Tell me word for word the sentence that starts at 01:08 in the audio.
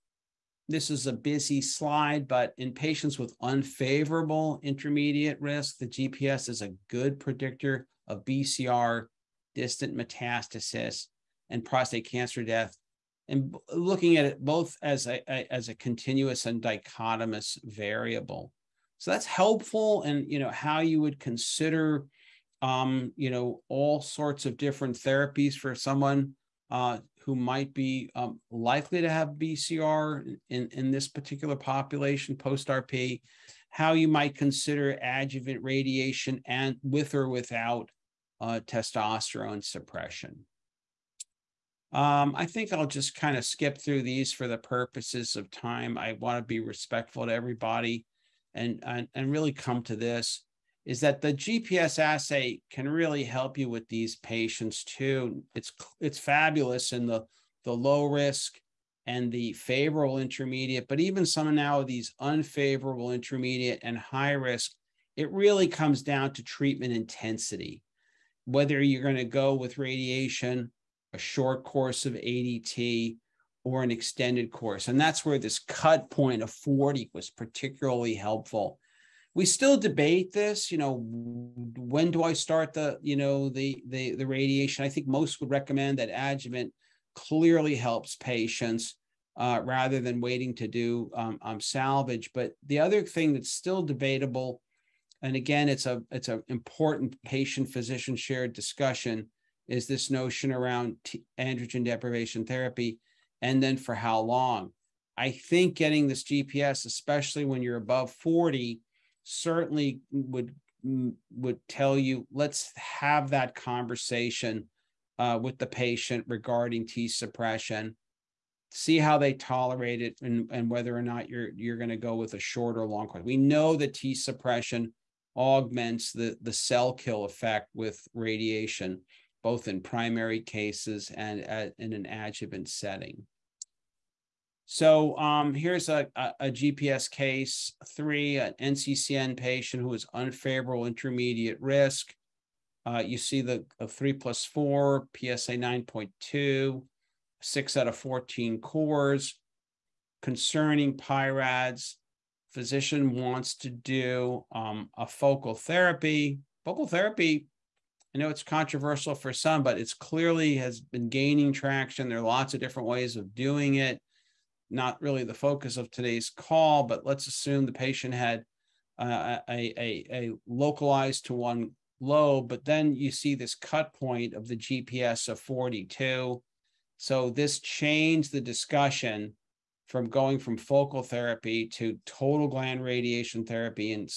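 Whether you're going to go with radiation a short course of ADT, or an extended course.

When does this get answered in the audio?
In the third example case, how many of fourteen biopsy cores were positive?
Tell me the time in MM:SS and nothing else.
02:27.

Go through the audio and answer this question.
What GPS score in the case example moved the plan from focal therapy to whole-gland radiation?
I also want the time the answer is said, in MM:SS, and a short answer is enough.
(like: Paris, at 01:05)
42, at 02:54.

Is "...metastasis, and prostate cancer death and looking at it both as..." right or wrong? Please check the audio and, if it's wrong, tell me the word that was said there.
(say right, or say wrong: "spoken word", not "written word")
right.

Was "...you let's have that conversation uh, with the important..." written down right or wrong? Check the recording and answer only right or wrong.
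wrong.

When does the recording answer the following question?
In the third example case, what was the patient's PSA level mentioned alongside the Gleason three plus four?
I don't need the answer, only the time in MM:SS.
02:25.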